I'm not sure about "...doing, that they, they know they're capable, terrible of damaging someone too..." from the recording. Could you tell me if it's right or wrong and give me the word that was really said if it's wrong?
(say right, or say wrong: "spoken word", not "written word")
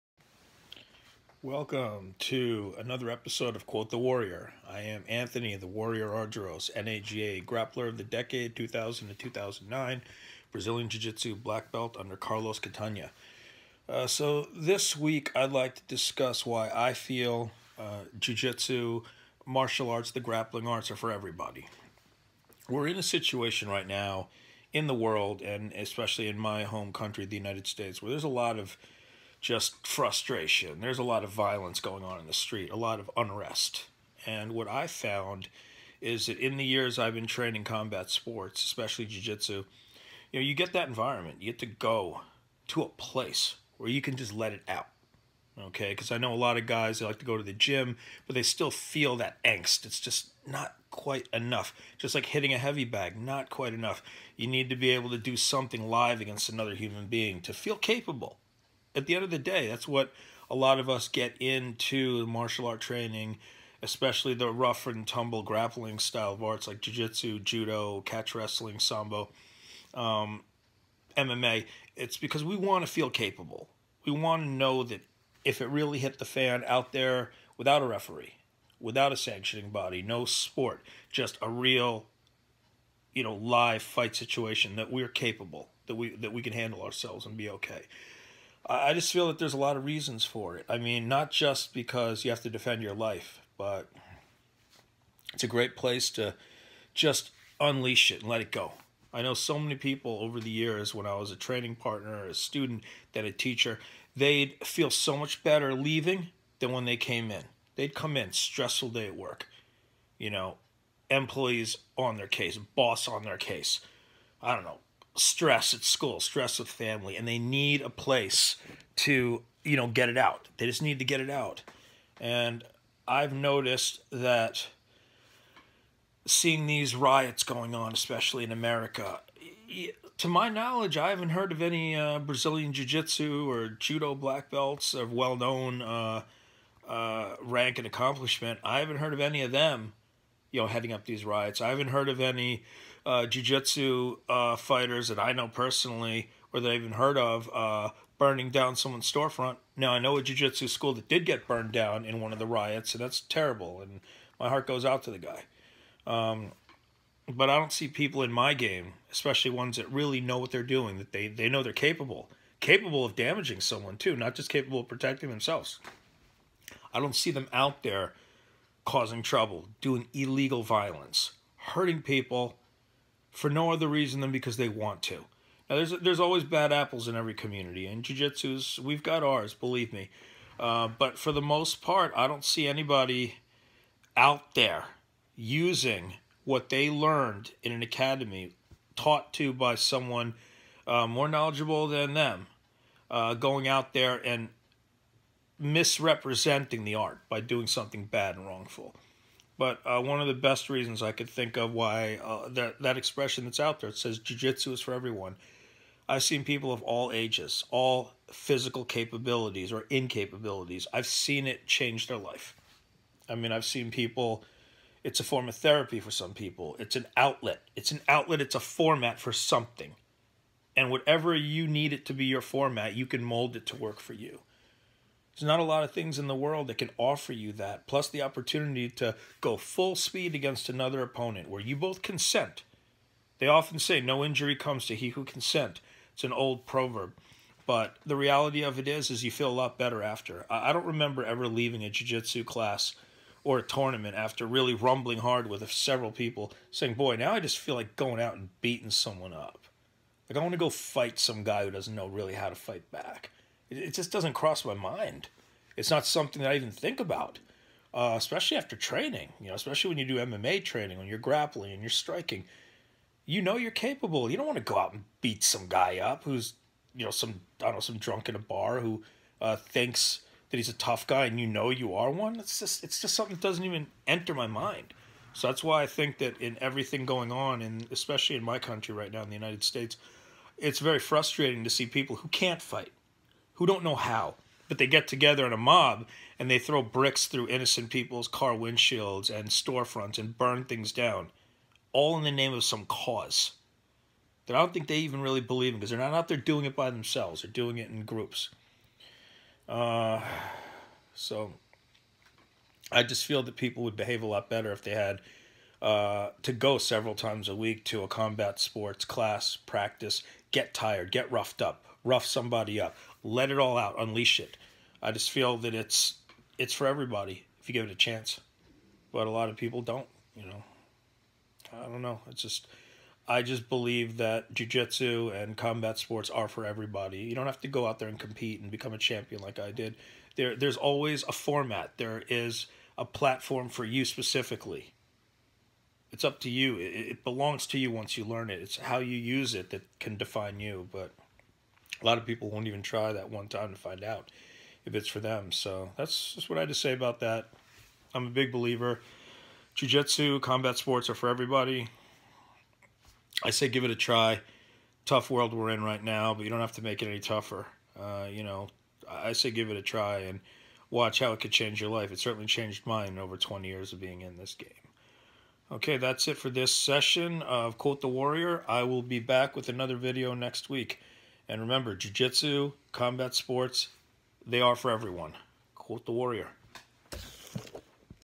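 wrong: "capable", not "terrible".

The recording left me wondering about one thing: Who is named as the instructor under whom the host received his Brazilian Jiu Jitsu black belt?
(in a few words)
Carlos Catania.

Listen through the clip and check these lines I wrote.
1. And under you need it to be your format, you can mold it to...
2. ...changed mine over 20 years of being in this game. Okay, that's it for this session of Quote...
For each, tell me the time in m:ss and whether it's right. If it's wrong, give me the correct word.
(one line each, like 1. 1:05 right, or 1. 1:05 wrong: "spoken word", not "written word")
1. 3:40 wrong: "whatever", not "under"
2. 6:02 right.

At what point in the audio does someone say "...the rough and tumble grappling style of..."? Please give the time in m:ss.
1:04.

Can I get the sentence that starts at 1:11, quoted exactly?
It's because we want to feel capable.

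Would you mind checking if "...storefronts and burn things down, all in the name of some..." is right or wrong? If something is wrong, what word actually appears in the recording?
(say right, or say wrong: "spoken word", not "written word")
right.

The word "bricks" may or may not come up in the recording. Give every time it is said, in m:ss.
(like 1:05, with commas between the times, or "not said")
4:46.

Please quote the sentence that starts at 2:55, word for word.
Now, there's there's always bad apples in every community, and jujitsu's we've got ours, believe me.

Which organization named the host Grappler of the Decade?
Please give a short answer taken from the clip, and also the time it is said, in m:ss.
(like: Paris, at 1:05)
NAGA, at 0:06.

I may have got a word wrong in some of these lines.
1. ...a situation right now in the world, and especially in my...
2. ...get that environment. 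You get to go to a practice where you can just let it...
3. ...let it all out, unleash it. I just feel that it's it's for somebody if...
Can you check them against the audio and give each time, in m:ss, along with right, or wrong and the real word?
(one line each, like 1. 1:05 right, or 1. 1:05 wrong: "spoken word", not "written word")
1. 0:22 right
2. 0:40 wrong: "place", not "practice"
3. 5:13 wrong: "everybody", not "somebody".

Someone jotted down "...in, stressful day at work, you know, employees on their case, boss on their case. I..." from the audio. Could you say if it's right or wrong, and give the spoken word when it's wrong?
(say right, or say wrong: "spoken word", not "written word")
right.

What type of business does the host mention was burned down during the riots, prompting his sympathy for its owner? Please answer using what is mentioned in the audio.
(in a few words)
A jiu-jitsu school.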